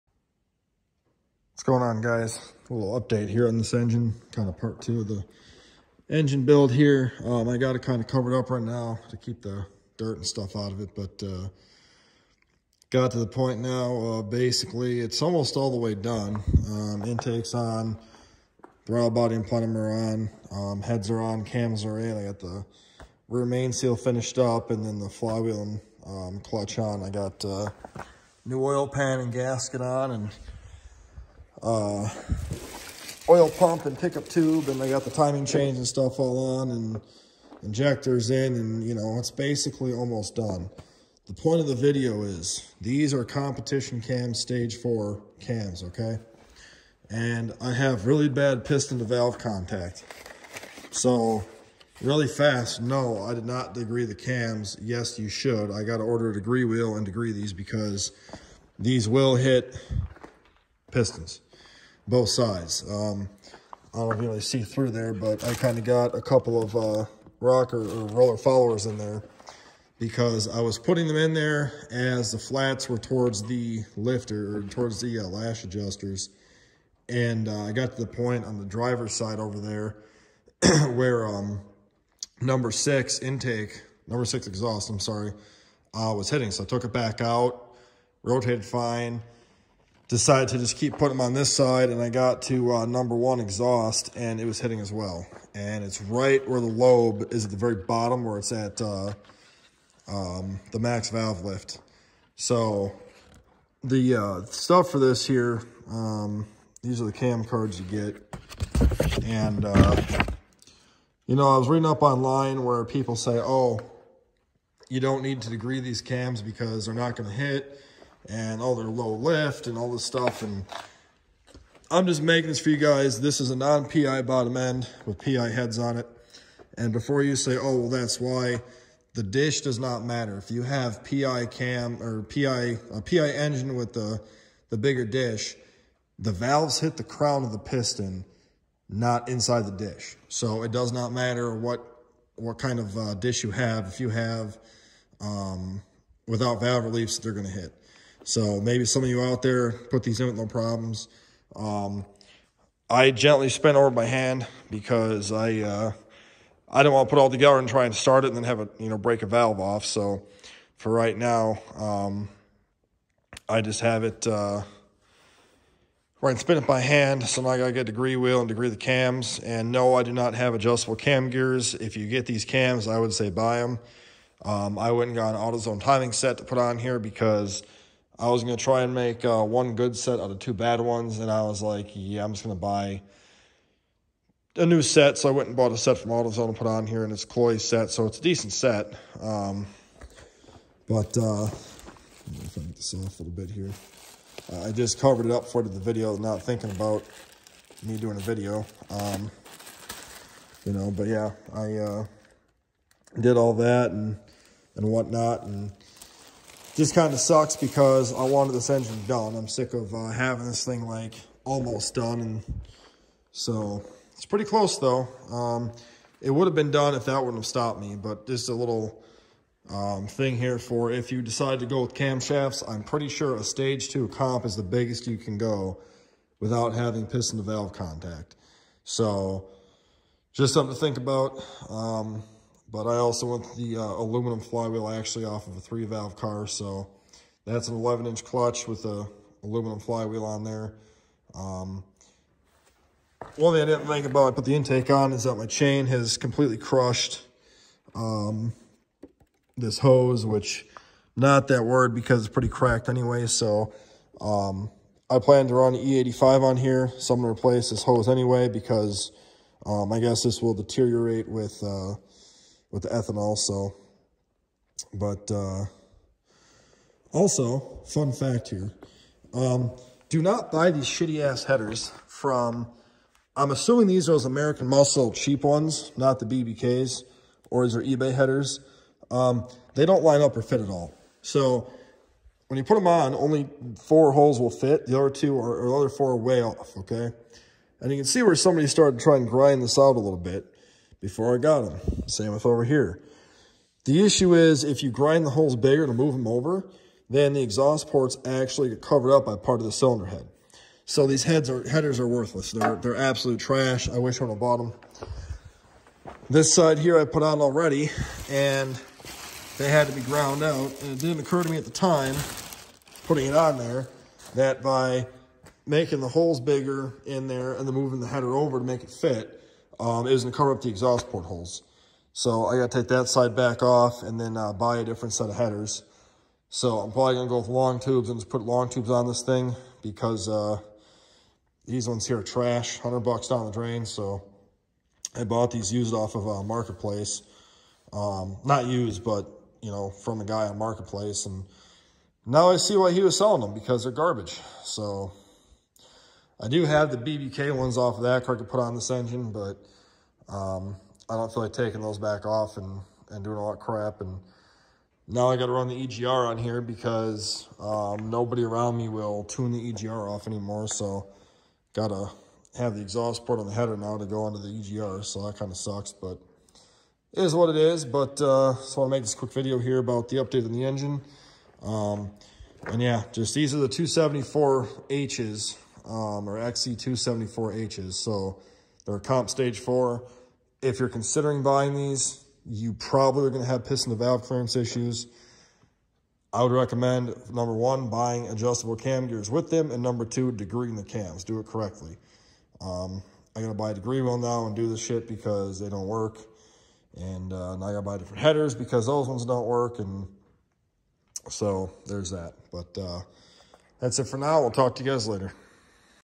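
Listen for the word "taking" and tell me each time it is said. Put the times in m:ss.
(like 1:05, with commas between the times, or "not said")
5:51.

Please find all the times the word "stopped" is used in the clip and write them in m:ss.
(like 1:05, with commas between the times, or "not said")
3:37.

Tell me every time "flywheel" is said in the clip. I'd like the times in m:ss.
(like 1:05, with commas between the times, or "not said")
0:25, 3:54, 3:59.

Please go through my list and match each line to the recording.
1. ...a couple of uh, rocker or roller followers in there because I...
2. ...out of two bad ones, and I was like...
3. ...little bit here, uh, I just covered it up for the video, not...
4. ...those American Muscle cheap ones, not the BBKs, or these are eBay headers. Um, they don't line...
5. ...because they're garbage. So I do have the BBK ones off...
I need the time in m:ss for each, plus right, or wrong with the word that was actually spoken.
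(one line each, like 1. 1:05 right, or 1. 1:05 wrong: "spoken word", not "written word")
1. 1:06 right
2. 3:00 right
3. 3:13 right
4. 4:34 right
5. 5:43 right.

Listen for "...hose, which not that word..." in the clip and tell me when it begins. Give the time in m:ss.
4:09.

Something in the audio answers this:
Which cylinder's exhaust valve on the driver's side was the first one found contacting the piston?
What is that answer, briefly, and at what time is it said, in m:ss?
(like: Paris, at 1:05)
Number 6, at 1:24.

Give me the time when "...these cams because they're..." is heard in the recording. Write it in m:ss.
1:55.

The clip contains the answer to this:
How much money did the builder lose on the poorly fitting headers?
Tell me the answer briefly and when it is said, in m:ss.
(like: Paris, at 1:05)
$100, at 5:32.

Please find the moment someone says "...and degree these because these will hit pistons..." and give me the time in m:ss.
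0:56.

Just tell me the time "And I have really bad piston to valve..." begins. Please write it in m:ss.
0:47.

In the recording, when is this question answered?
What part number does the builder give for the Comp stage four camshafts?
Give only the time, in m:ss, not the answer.
6:16.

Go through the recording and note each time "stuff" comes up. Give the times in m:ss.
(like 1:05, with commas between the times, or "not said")
0:10, 0:35, 1:44, 2:00.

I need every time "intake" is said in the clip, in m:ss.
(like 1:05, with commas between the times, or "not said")
0:17, 1:23, 4:04.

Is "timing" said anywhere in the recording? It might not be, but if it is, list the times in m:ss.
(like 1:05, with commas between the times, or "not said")
0:35, 2:55.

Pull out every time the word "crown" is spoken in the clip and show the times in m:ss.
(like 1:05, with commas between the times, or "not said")
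2:17.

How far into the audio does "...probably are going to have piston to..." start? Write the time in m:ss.
6:22.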